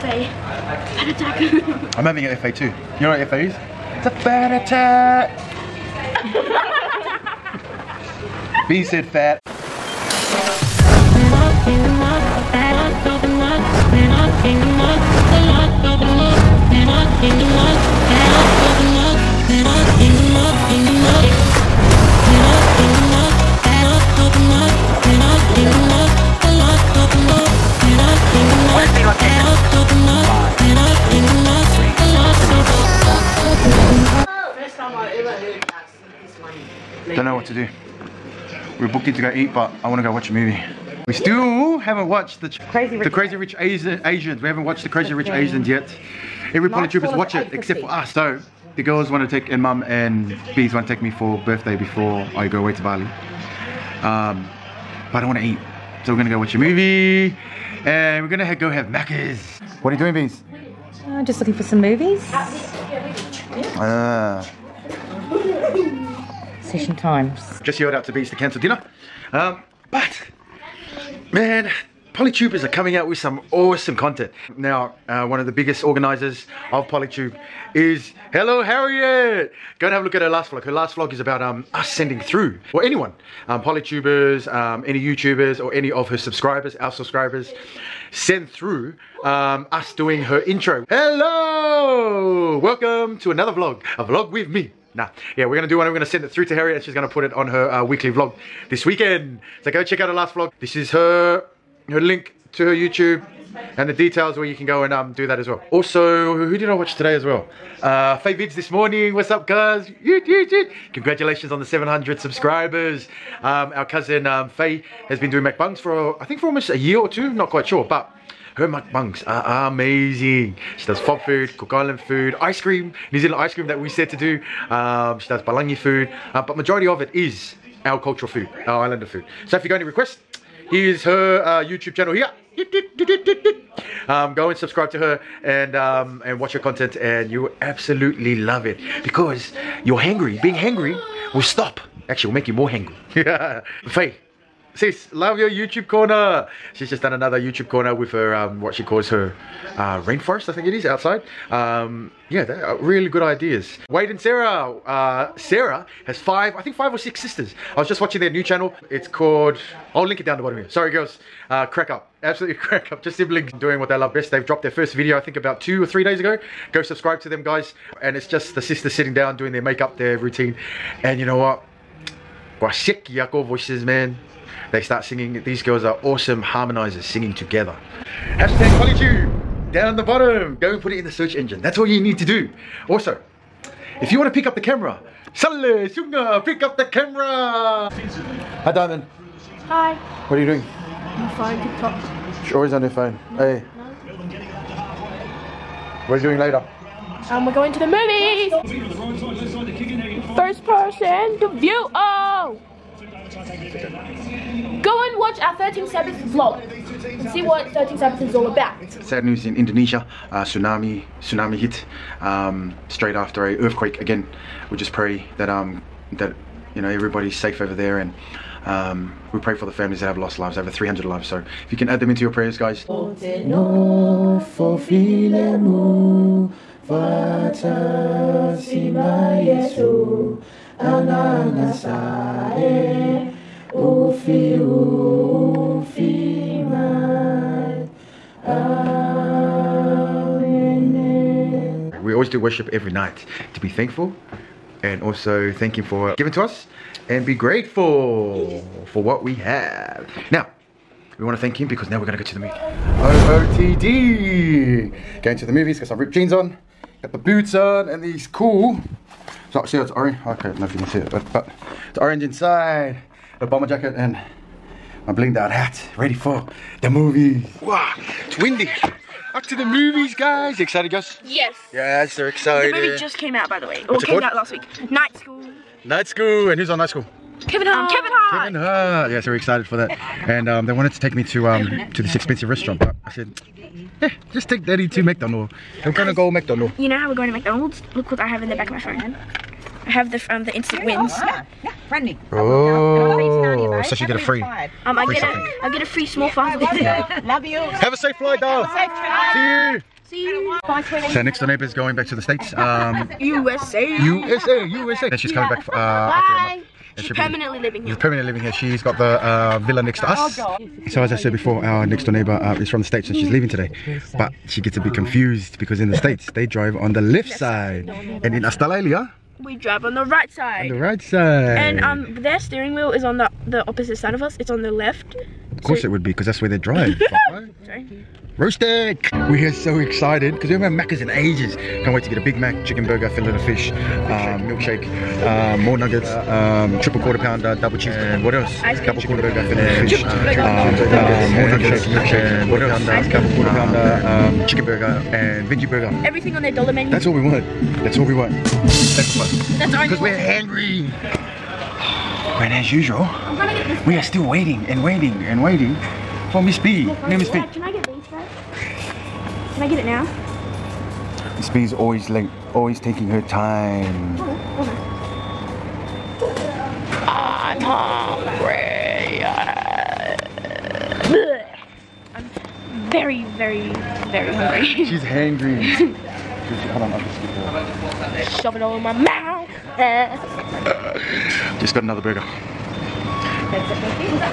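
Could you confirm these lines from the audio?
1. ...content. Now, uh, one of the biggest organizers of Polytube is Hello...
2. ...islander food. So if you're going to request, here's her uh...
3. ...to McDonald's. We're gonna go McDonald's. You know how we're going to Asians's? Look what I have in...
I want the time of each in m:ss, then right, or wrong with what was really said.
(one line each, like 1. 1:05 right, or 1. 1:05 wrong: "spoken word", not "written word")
1. 1:13 right
2. 2:08 right
3. 4:44 wrong: "McDonald", not "Asians".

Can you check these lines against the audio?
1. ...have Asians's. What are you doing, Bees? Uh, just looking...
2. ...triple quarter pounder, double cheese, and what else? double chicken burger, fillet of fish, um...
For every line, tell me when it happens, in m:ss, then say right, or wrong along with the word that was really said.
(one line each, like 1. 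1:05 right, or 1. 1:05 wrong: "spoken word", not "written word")
1. 0:58 wrong: "Macca", not "Asians"
2. 5:36 right.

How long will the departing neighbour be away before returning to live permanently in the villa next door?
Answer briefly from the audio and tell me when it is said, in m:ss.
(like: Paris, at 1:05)
a month, at 5:06.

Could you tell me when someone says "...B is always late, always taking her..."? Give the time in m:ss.
6:01.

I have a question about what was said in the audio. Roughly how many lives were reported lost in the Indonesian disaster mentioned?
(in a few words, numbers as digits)
over 300.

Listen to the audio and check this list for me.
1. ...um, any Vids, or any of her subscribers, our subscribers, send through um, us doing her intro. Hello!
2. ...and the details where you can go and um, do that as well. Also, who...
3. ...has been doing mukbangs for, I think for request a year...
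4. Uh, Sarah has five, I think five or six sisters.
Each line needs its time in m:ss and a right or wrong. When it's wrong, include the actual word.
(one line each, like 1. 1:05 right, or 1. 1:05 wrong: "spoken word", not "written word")
1. 1:24 wrong: "YouTubers", not "Vids"
2. 1:43 right
3. 1:55 wrong: "almost", not "request"
4. 2:34 right.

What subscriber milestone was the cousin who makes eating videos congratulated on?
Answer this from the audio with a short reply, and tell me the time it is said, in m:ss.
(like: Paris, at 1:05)
700, at 1:51.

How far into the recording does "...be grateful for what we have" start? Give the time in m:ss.
4:07.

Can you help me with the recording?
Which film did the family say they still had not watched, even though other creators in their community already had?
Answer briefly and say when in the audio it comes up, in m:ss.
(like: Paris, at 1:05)
Crazy Rich Asians, at 0:44.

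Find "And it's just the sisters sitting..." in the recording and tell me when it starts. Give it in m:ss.
2:47.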